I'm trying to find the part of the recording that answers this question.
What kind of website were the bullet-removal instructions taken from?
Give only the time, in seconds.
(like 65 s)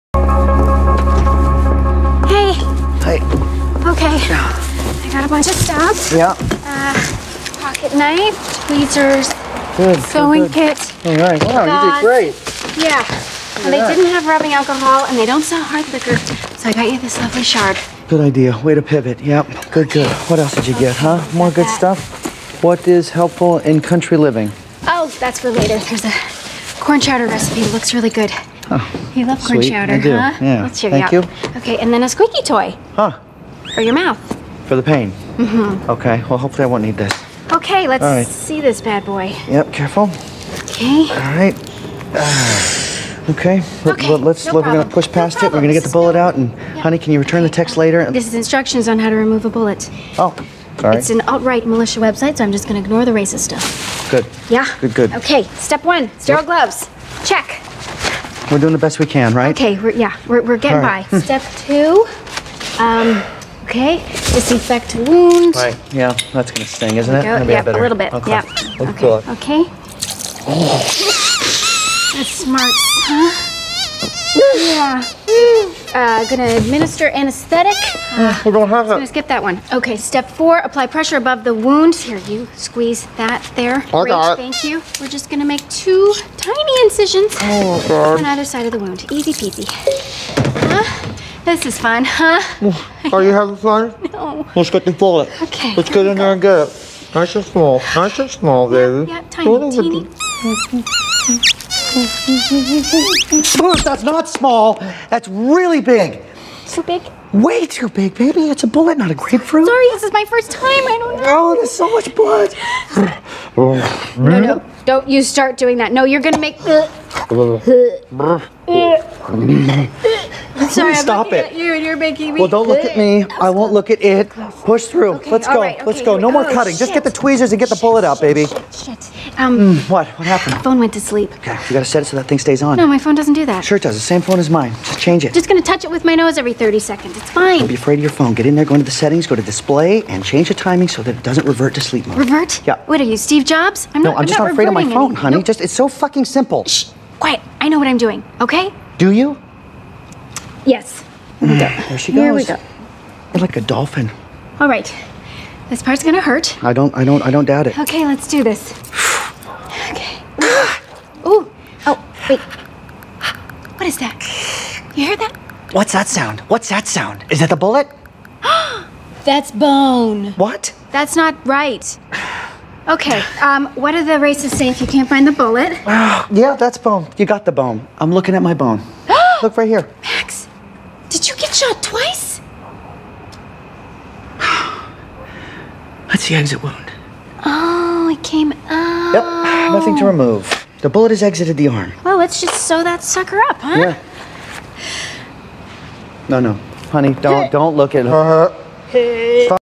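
51 s.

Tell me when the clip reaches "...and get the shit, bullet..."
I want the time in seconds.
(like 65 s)
127 s.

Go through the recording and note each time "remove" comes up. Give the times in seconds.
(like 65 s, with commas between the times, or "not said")
49 s, 190 s.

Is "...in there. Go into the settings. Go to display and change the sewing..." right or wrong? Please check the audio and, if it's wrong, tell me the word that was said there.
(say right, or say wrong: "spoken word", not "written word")
wrong: "timing", not "sewing".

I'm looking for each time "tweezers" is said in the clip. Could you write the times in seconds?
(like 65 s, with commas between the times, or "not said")
8 s, 127 s.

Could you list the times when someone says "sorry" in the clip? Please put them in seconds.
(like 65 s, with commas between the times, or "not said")
109 s, 120 s.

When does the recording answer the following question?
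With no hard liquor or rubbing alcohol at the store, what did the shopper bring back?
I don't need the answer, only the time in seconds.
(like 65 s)
17 s.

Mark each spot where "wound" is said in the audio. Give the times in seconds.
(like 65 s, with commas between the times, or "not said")
64 s, 81 s, 88 s, 186 s.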